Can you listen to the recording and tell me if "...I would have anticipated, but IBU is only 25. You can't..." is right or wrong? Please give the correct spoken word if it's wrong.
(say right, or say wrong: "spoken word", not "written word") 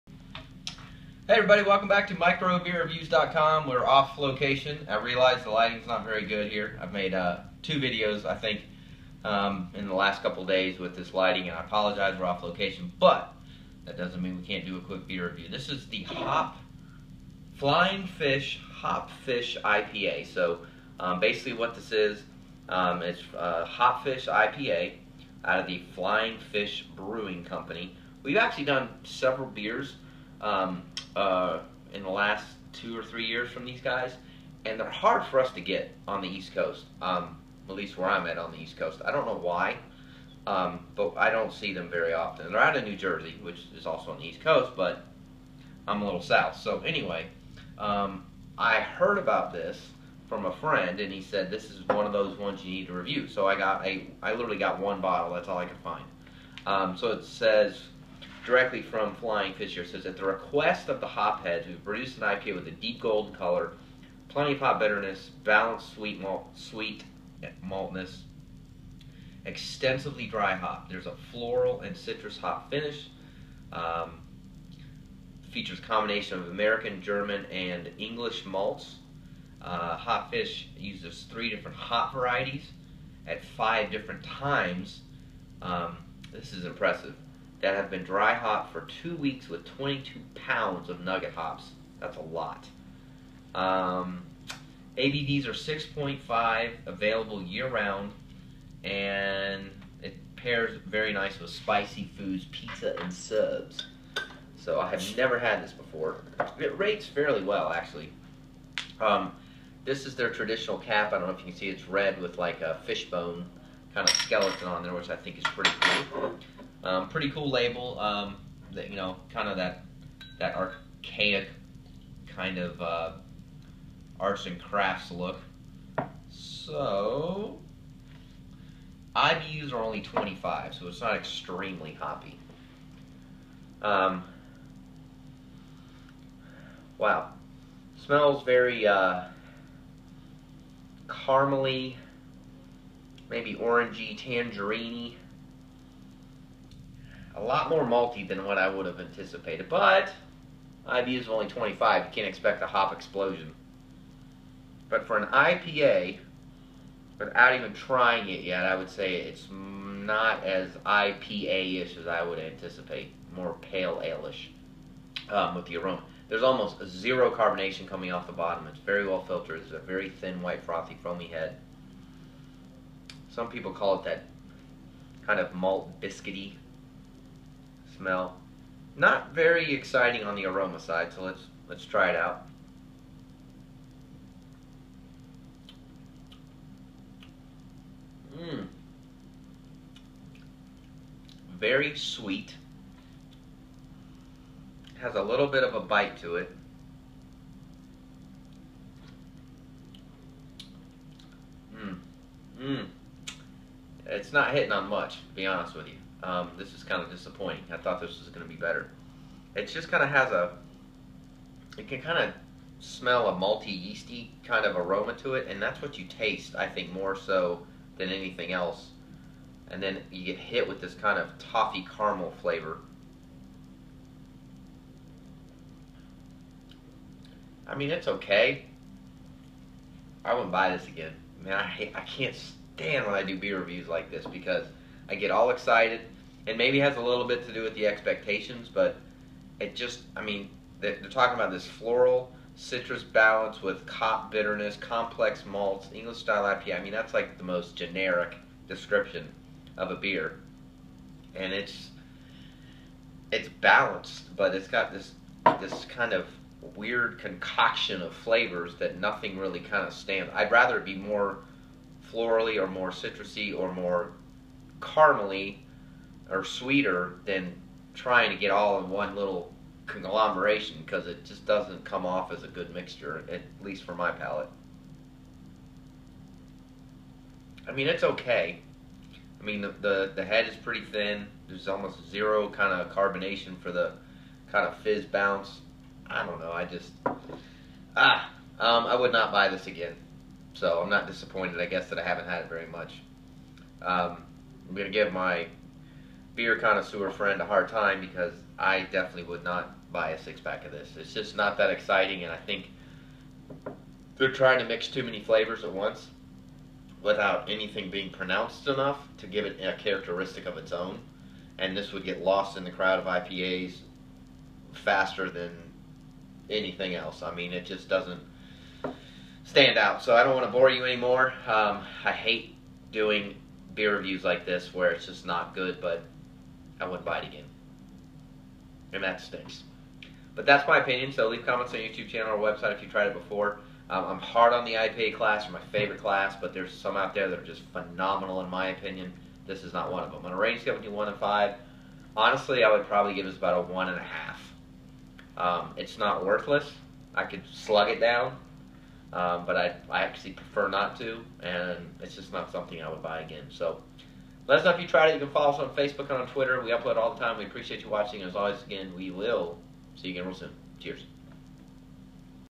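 right.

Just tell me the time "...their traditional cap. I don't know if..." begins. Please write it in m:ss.
1:50.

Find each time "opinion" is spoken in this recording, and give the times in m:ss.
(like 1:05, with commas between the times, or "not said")
5:30, 5:38.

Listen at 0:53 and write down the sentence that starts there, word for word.
So I got a, I literally got one bottle.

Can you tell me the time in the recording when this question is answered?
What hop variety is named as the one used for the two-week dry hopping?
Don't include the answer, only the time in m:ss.
1:31.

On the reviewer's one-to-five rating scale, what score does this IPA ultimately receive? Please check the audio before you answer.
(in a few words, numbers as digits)
1.5.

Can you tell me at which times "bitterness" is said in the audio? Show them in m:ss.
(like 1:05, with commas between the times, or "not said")
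1:04, 4:04.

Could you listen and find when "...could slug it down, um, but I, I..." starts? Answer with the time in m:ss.
5:47.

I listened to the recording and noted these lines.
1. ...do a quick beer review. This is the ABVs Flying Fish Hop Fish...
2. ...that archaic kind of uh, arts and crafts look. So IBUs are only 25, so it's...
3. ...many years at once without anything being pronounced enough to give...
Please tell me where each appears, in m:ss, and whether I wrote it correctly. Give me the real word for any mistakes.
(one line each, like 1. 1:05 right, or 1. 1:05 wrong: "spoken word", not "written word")
1. 0:14 wrong: "Hop", not "ABVs"
2. 2:00 right
3. 5:05 wrong: "flavors", not "years".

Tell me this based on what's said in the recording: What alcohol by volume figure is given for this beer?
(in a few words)
6.5.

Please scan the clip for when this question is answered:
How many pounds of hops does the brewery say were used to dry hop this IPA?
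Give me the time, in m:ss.
1:29.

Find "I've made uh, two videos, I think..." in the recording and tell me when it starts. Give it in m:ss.
0:06.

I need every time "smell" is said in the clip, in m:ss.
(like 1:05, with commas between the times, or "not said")
2:17, 2:58, 3:32.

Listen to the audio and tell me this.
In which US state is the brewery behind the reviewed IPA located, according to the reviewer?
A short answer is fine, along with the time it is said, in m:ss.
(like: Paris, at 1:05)
New Jersey, at 0:42.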